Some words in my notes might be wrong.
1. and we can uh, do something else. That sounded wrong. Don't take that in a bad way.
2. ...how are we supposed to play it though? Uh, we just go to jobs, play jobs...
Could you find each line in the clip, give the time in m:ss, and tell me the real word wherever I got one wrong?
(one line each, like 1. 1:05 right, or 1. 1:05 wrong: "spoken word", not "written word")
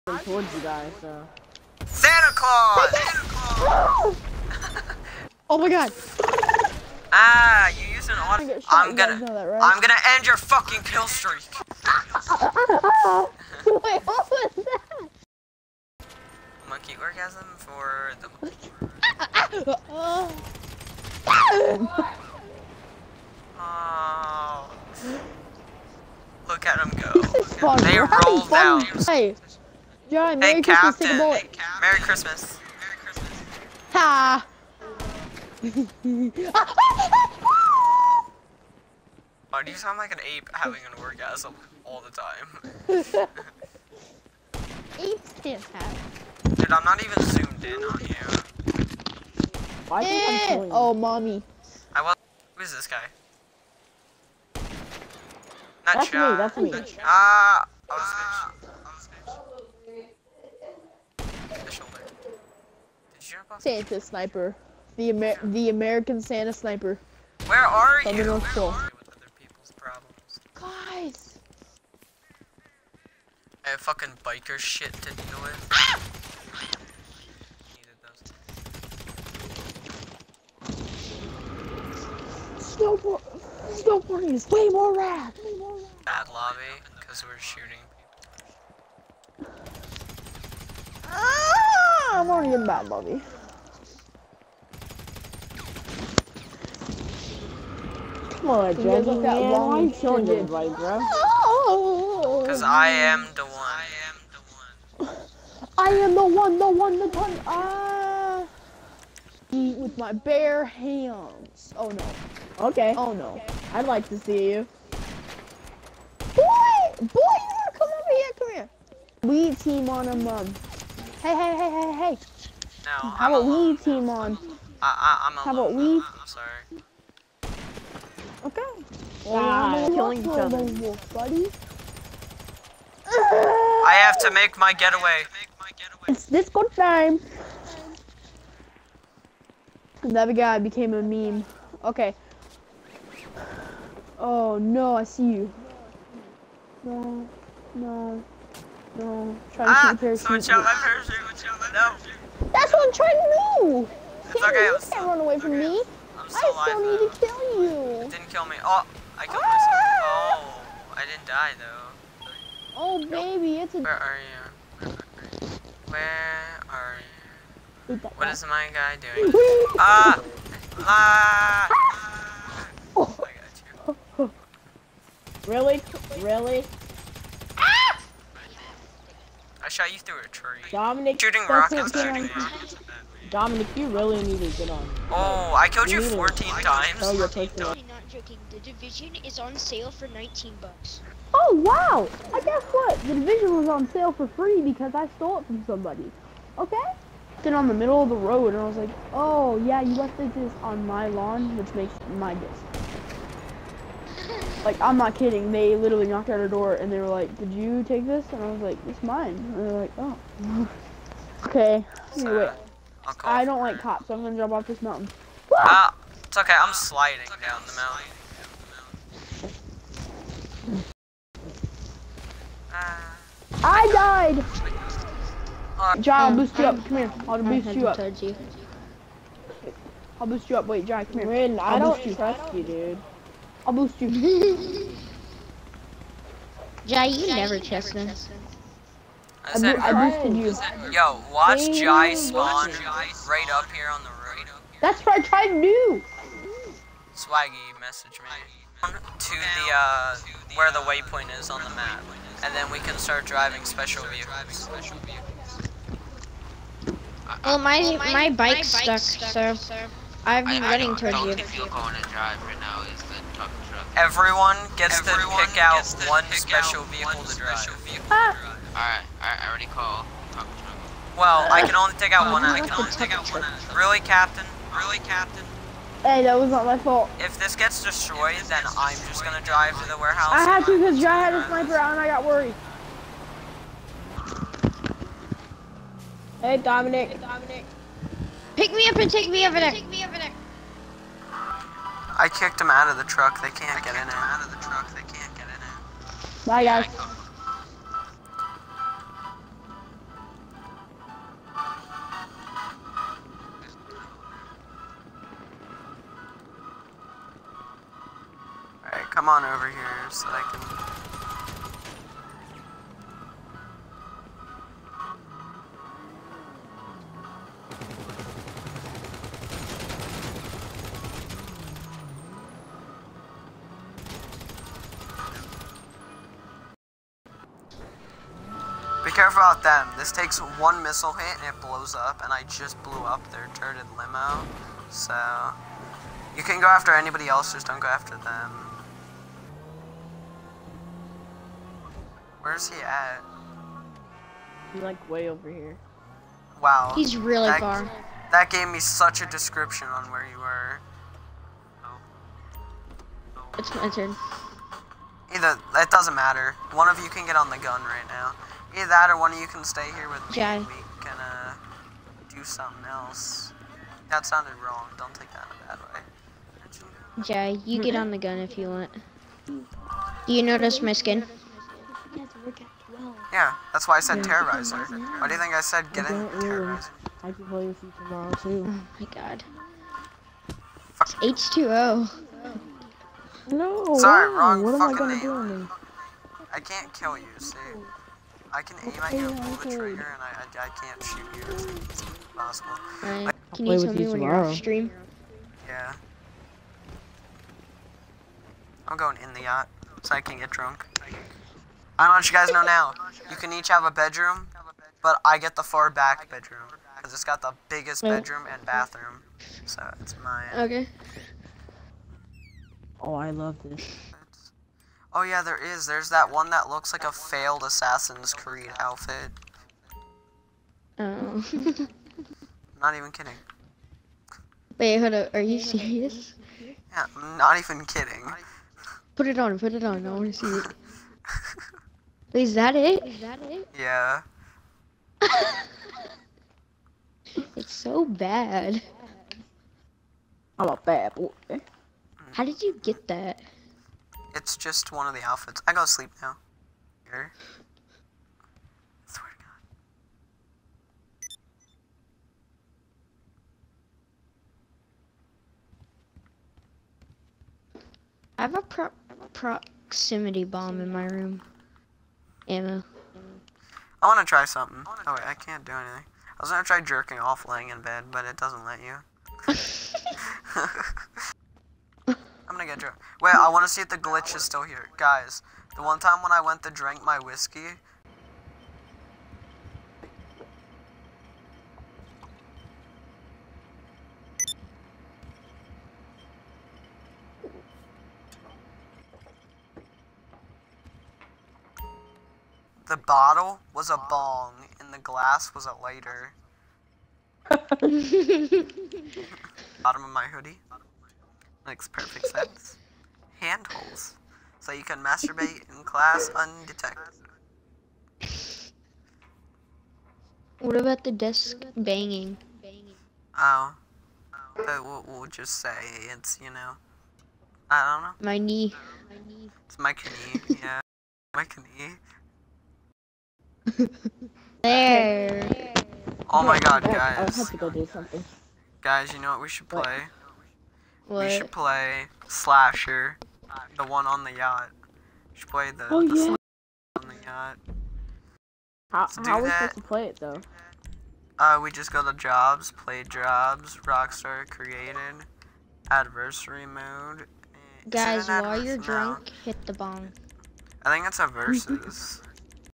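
1. 6:00 right
2. 8:59 right.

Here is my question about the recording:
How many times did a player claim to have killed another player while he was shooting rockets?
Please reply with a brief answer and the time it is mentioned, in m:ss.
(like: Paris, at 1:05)
14, at 3:06.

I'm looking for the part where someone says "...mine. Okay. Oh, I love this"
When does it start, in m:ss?
6:50.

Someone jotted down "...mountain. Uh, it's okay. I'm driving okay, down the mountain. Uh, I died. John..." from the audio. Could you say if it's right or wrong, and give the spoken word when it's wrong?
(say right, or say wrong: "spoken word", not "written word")
wrong: "sliding", not "driving".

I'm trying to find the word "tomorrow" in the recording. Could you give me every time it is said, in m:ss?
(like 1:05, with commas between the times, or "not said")
6:17, 6:34.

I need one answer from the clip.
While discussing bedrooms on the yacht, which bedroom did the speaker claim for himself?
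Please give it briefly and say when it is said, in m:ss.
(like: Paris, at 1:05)
The far back bedroom, at 6:45.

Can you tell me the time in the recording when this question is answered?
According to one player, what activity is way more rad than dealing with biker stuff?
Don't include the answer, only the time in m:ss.
1:23.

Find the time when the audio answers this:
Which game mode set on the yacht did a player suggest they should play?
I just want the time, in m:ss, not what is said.
8:52.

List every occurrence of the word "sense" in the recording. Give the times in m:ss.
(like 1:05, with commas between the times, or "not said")
8:22.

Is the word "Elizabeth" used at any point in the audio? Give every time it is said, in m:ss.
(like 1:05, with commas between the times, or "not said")
not said.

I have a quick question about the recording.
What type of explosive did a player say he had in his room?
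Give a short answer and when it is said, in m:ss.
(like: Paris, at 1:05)
Proximity bomb, at 7:39.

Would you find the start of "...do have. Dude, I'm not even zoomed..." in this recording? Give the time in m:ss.
0:45.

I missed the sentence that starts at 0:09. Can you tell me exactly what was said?
I'm gonna end your fucking kill streak!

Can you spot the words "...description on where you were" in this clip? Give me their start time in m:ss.
5:49.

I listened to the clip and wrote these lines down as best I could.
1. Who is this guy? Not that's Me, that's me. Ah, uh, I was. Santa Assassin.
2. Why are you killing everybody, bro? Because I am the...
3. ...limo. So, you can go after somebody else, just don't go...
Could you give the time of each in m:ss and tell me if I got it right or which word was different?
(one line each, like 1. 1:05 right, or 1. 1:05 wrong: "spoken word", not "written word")
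1. 0:52 wrong: "Sniper", not "Assassin"
2. 1:39 right
3. 5:33 wrong: "anybody", not "somebody".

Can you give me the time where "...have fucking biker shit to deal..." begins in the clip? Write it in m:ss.
1:13.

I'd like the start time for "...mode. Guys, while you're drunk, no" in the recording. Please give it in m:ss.
9:06.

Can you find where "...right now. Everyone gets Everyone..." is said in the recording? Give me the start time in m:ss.
4:22.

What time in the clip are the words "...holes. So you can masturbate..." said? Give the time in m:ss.
8:23.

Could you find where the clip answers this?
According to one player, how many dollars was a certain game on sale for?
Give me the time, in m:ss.
3:10.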